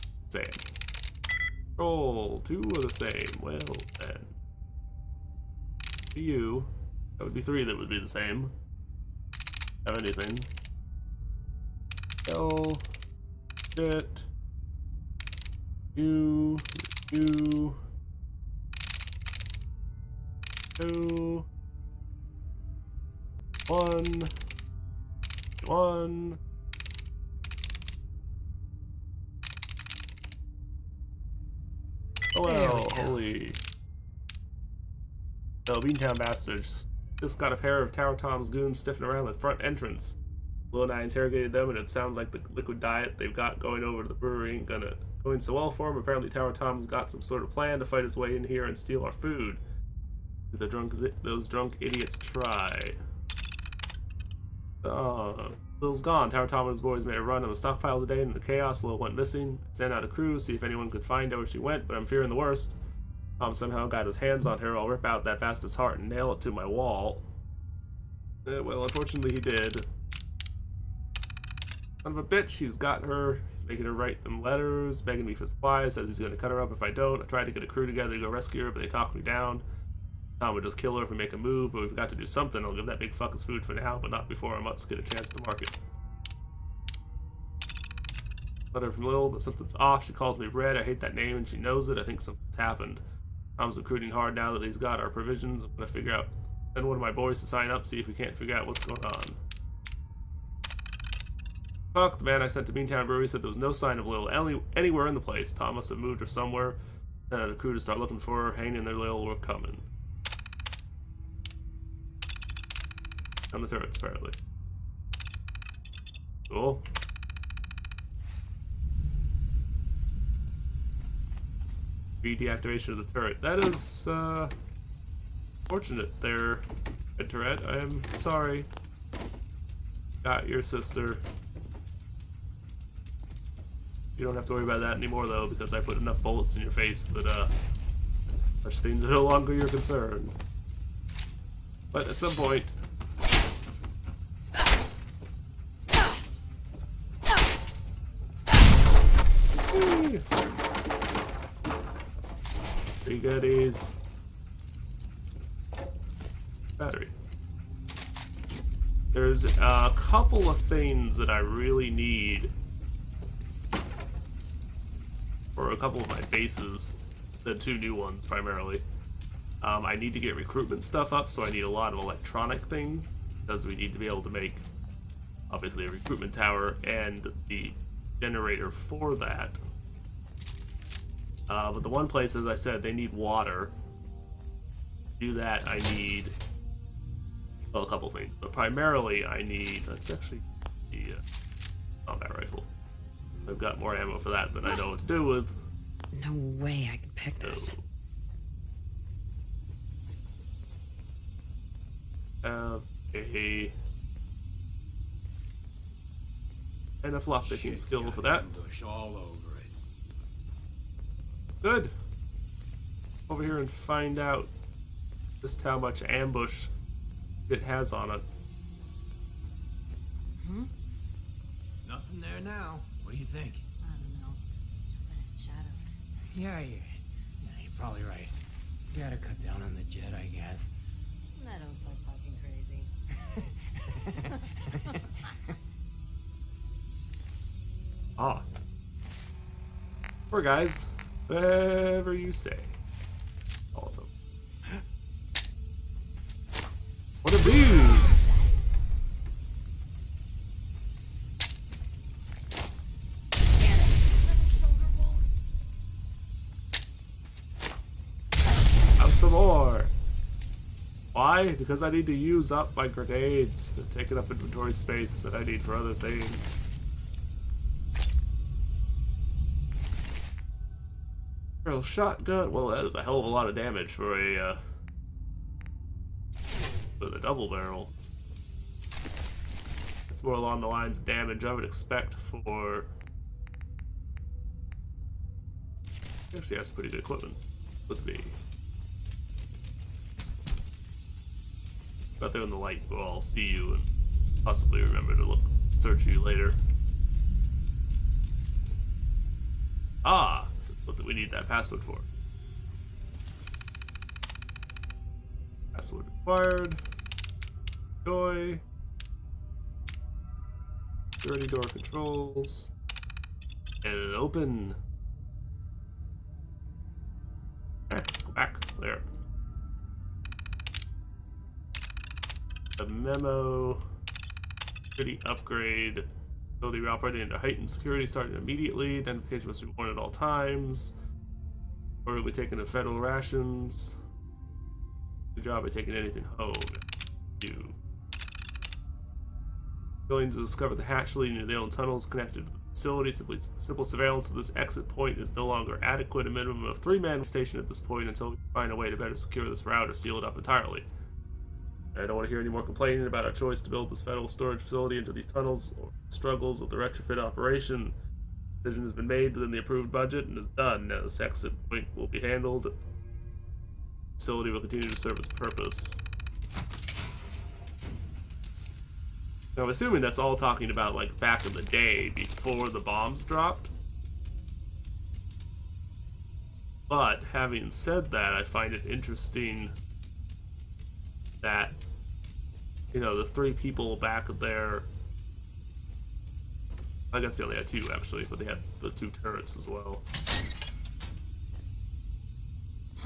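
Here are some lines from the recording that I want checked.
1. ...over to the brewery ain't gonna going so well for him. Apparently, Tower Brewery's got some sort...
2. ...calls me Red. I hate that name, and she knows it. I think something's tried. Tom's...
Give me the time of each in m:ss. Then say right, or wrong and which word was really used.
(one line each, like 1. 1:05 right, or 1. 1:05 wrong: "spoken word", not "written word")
1. 0:43 wrong: "Tom", not "Brewery"
2. 1:30 wrong: "happened", not "tried".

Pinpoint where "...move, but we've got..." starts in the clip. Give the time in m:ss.
1:21.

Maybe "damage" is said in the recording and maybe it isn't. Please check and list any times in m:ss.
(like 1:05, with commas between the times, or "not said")
4:33, 4:41.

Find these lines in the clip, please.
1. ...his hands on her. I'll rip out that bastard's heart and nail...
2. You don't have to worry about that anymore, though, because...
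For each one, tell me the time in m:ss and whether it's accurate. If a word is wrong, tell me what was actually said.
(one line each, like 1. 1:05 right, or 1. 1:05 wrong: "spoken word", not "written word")
1. 1:04 right
2. 2:14 right.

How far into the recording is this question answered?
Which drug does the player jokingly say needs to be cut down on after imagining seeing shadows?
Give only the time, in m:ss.
3:49.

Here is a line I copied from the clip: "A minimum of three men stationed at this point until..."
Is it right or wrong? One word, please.
right.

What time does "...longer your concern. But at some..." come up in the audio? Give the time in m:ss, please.
2:19.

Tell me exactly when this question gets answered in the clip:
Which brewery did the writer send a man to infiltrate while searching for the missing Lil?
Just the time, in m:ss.
1:42.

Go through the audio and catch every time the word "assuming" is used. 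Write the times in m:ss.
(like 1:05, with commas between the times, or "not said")
6:09.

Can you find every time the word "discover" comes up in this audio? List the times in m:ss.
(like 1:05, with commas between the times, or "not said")
5:40.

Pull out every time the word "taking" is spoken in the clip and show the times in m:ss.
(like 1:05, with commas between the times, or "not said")
4:24, 5:35.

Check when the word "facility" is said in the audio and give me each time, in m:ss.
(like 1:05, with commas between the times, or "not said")
5:42, 5:54, 6:04.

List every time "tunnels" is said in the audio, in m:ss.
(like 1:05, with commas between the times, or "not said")
5:41, 5:55.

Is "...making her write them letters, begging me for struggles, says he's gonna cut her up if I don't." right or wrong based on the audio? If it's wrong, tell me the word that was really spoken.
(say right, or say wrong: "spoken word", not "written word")
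wrong: "supplies", not "struggles".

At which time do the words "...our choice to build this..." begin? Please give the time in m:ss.
5:53.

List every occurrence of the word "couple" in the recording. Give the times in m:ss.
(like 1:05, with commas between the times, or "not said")
2:39, 2:45, 3:07.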